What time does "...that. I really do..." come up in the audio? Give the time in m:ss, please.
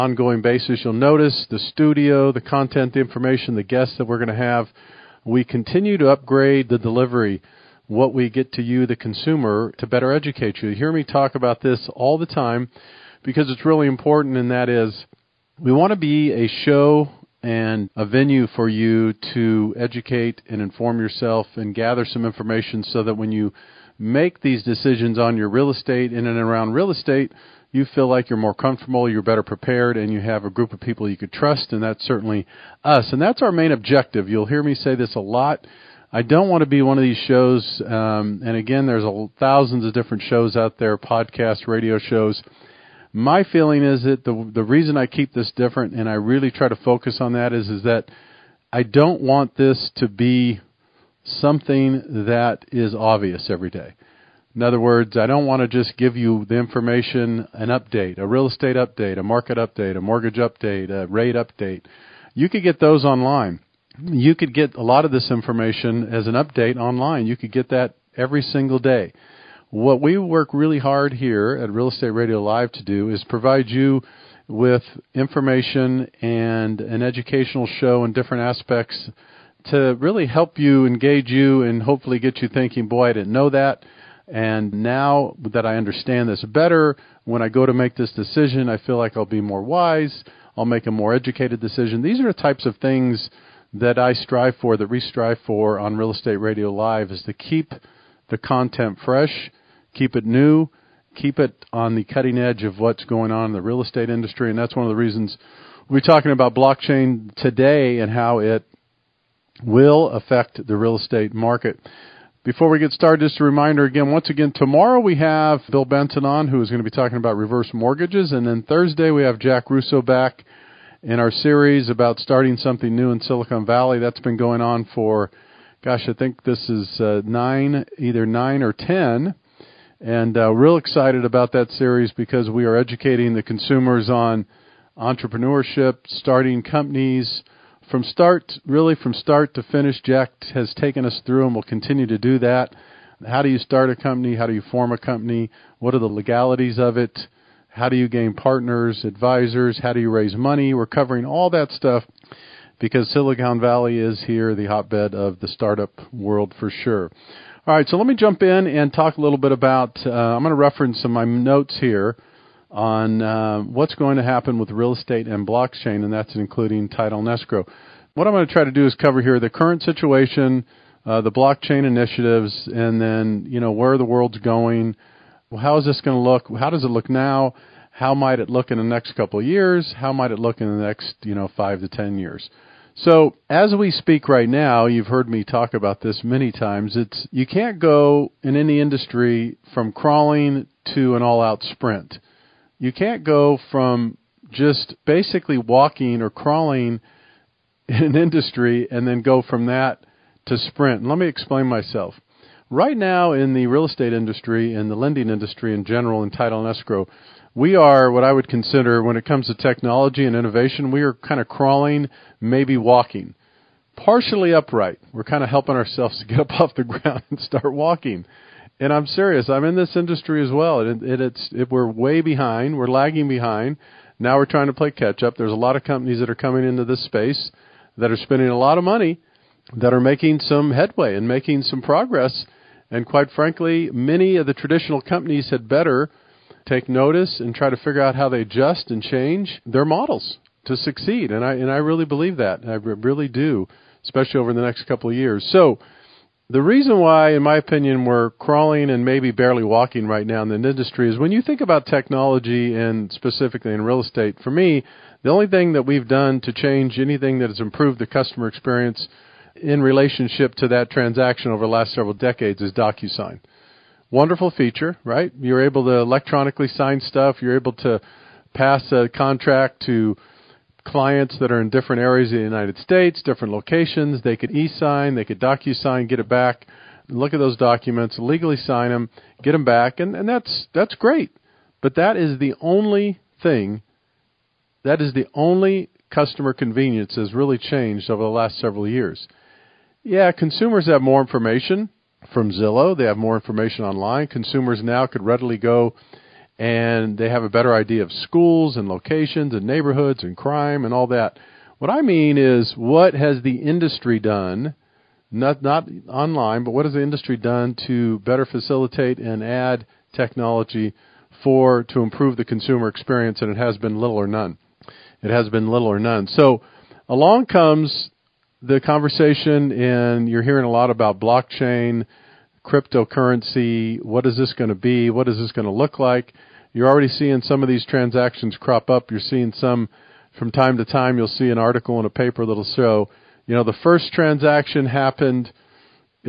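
4:02.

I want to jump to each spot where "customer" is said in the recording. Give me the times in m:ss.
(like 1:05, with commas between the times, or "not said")
4:18, 4:46.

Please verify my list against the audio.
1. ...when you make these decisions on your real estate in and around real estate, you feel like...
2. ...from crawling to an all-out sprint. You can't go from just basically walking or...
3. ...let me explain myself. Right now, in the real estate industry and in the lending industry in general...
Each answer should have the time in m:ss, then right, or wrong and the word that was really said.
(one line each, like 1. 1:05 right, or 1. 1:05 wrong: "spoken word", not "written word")
1. 0:23 right
2. 3:09 right
3. 3:21 right.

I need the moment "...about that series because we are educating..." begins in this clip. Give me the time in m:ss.
2:11.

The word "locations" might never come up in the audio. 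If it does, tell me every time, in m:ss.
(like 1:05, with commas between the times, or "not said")
4:33, 4:58.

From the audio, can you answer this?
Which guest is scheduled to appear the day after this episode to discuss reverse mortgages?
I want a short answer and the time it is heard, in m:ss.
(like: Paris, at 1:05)
Bill Benton, at 1:55.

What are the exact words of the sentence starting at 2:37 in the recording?
All right, so let me jump in and talk a little bit about.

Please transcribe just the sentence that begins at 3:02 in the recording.
So as we speak right now, you've heard me talk about this many times.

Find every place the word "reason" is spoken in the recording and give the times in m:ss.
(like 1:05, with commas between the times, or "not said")
0:44, 1:44, 4:06.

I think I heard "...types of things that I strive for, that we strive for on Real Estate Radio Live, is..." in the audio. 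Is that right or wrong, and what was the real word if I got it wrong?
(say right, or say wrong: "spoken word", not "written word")
right.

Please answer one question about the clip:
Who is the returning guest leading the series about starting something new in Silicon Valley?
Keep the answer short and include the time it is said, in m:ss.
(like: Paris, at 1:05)
Jack Russo, at 1:59.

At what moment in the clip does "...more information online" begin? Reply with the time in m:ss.
4:53.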